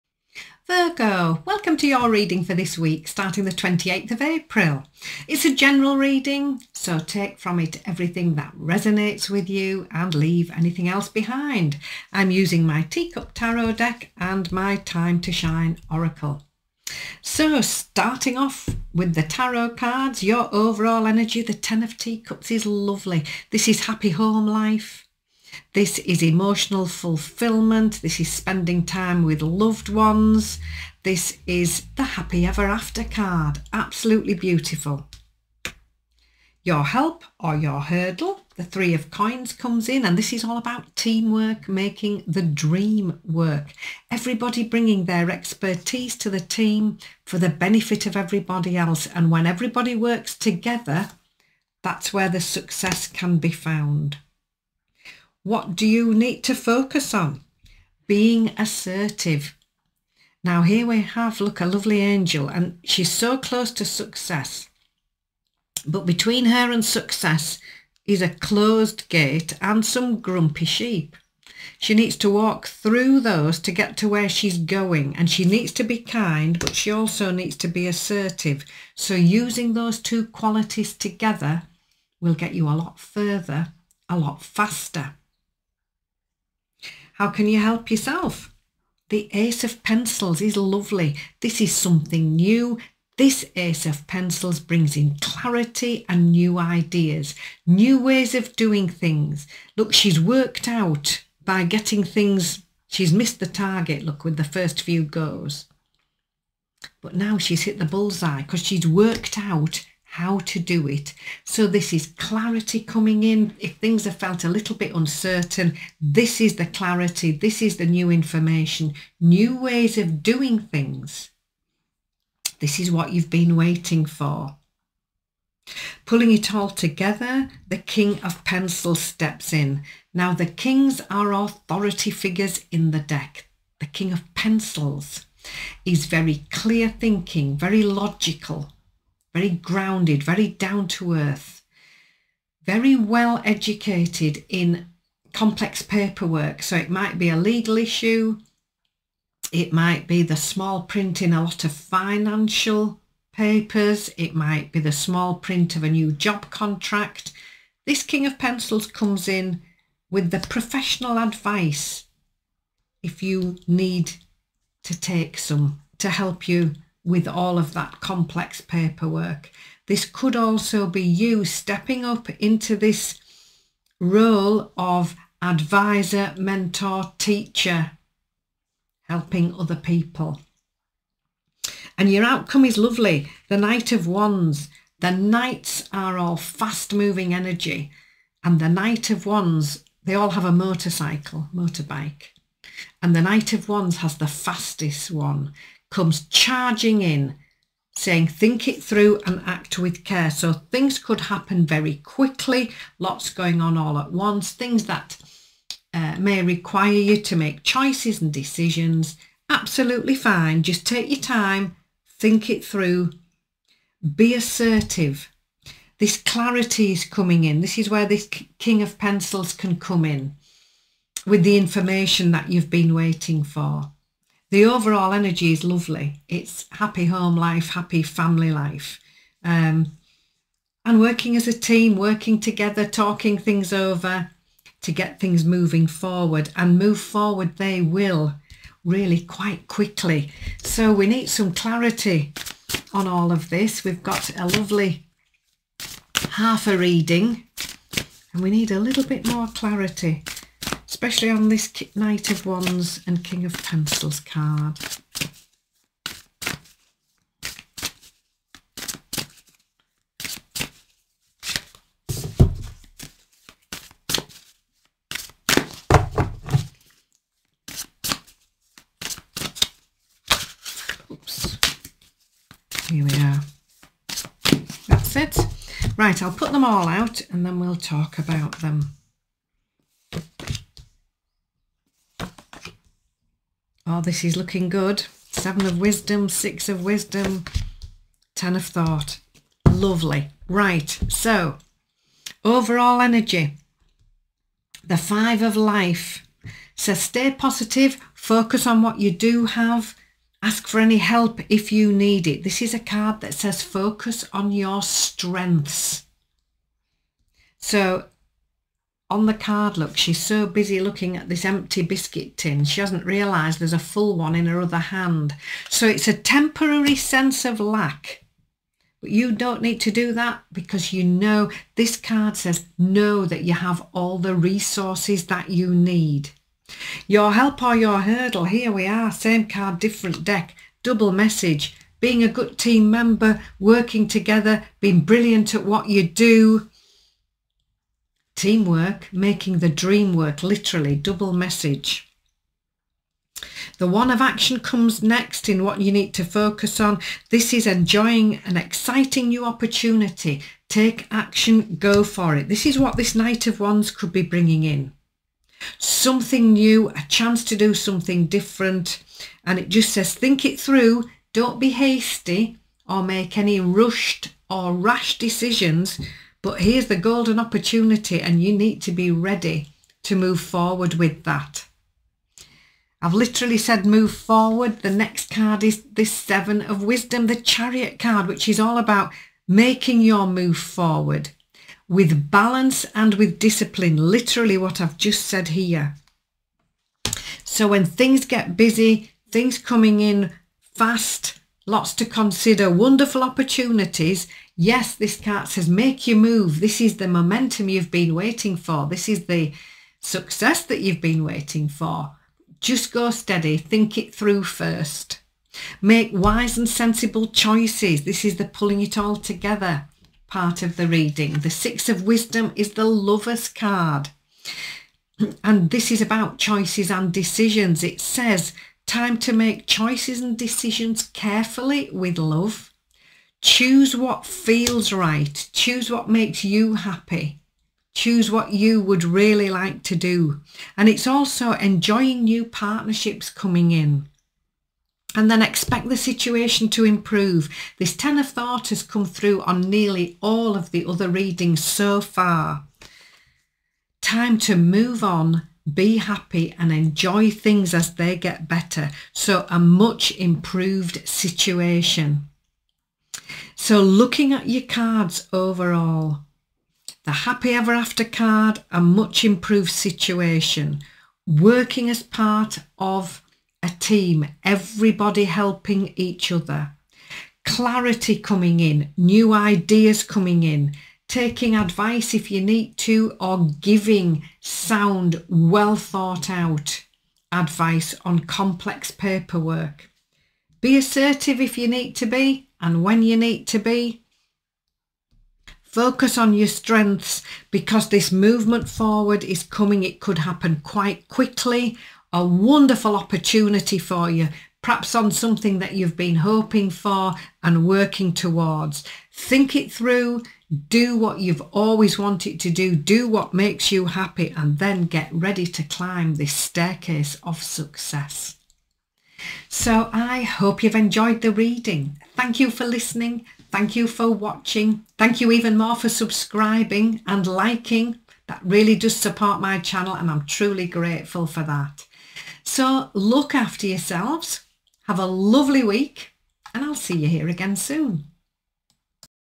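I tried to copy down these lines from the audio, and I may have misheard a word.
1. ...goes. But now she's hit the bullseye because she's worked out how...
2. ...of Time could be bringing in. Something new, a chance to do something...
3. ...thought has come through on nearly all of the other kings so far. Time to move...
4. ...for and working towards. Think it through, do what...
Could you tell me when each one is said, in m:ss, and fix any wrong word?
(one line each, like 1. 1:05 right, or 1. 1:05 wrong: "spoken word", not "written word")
1. 1:45 right
2. 5:53 wrong: "Wands", not "Time"
3. 7:18 wrong: "readings", not "kings"
4. 8:16 right.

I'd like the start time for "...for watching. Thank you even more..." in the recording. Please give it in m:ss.
8:33.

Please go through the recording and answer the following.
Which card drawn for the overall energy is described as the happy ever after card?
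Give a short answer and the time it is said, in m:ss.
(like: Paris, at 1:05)
Ten of Teacups, at 0:21.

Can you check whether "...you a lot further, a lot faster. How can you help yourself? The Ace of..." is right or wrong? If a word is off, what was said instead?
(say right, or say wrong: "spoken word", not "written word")
right.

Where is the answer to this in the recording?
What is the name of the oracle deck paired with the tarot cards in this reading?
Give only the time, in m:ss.
0:14.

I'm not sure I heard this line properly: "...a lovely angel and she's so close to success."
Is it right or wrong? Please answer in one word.
right.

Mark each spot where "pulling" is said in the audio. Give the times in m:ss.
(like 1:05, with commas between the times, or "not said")
2:06, 6:48.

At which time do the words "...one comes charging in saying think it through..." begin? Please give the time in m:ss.
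3:15.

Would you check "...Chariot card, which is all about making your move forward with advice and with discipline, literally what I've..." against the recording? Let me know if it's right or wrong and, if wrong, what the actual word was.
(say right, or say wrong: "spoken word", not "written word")
wrong: "balance", not "advice".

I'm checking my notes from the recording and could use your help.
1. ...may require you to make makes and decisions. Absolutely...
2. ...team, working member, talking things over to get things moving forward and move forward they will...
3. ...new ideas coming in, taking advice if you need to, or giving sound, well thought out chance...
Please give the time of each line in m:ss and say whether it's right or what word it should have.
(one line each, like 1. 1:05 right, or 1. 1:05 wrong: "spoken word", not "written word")
1. 3:26 wrong: "choices", not "makes"
2. 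3:51 wrong: "together", not "member"
3. 7:48 wrong: "advice", not "chance".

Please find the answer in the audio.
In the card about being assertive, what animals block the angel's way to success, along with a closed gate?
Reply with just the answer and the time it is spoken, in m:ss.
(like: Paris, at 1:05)
grumpy sheep, at 1:10.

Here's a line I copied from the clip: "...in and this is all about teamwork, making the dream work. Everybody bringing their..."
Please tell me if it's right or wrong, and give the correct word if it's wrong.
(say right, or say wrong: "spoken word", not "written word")
right.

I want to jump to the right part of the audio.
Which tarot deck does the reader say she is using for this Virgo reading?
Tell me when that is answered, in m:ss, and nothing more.
0:12.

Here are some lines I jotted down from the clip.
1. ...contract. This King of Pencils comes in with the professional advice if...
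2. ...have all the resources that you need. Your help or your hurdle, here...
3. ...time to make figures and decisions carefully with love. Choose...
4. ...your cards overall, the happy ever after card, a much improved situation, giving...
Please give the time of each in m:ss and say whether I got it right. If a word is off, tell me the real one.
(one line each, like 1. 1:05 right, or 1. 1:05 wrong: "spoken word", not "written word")
1. 2:36 right
2. 5:23 right
3. 6:58 wrong: "choices", not "figures"
4. 7:34 wrong: "working", not "giving".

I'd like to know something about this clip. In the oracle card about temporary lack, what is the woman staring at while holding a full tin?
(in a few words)
empty biscuit tin.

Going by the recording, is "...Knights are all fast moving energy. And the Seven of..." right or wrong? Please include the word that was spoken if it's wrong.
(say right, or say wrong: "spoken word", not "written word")
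wrong: "Knight", not "Seven".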